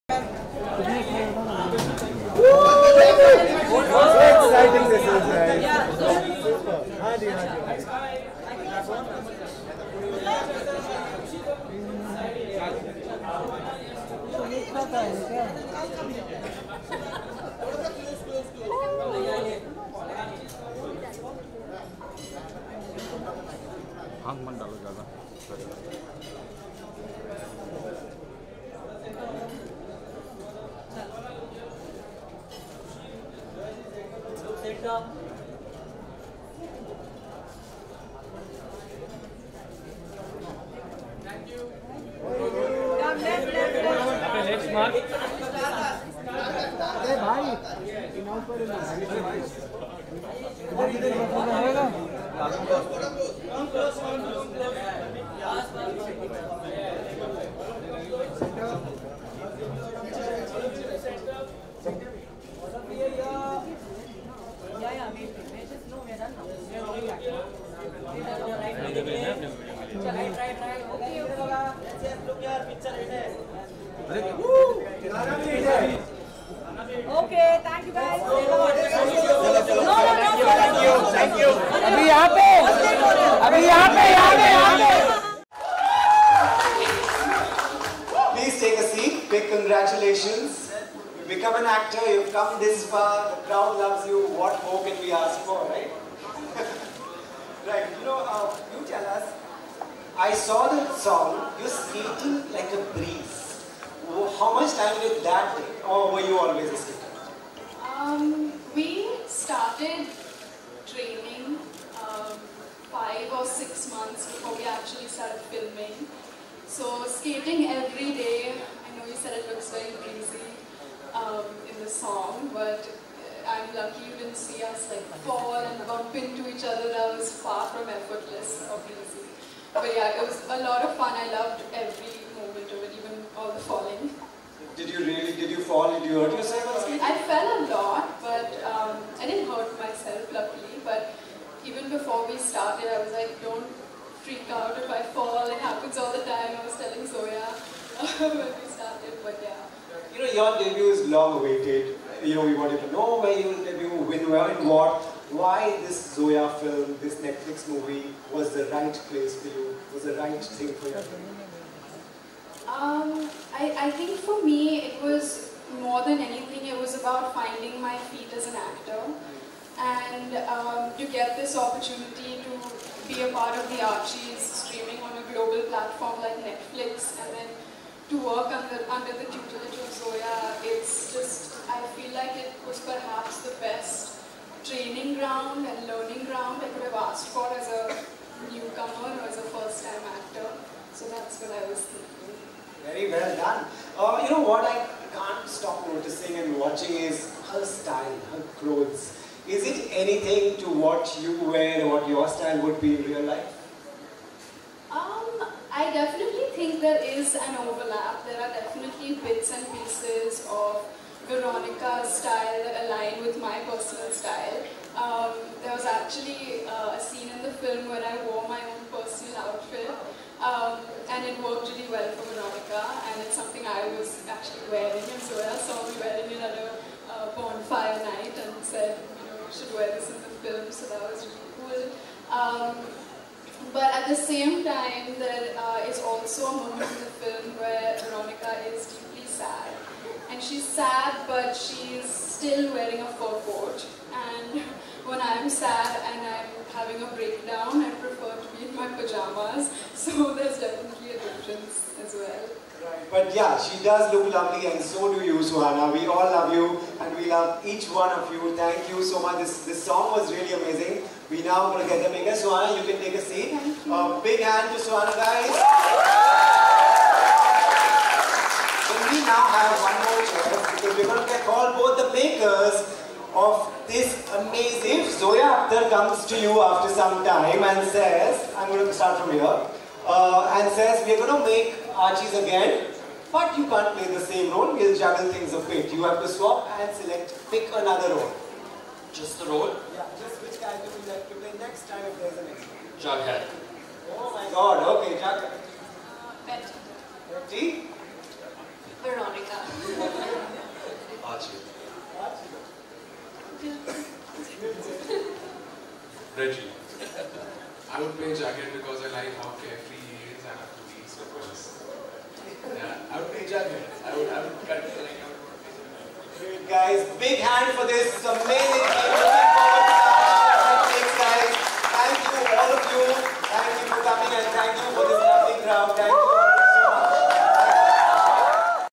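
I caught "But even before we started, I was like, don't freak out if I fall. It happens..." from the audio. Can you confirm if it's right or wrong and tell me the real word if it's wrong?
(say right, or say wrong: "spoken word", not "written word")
right.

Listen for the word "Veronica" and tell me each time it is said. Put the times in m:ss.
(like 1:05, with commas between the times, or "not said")
3:31, 3:42, 3:58, 4:59.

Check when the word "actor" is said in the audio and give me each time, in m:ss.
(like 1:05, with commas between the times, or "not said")
1:31, 2:48, 3:10.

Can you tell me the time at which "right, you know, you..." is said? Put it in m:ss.
1:37.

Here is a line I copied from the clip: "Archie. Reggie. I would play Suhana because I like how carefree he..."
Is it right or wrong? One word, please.
wrong.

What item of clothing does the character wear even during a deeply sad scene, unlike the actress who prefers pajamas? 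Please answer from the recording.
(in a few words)
Fur coat.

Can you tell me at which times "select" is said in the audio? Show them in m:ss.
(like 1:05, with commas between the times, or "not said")
4:46.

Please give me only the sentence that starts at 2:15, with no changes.
Did you hurt yourself or something?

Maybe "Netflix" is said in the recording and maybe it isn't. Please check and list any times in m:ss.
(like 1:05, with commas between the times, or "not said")
2:37, 2:56.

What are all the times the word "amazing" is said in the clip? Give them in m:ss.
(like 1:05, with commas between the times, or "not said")
4:20, 4:34, 5:18.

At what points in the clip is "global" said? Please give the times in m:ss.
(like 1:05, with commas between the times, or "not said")
2:55.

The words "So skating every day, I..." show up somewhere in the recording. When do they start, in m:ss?
1:56.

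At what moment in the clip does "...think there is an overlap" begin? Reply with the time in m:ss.
3:26.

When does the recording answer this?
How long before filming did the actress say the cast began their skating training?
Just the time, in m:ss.
1:52.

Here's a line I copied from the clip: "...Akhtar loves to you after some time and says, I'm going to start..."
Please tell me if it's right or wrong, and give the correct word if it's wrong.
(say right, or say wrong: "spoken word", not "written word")
wrong: "comes", not "loves".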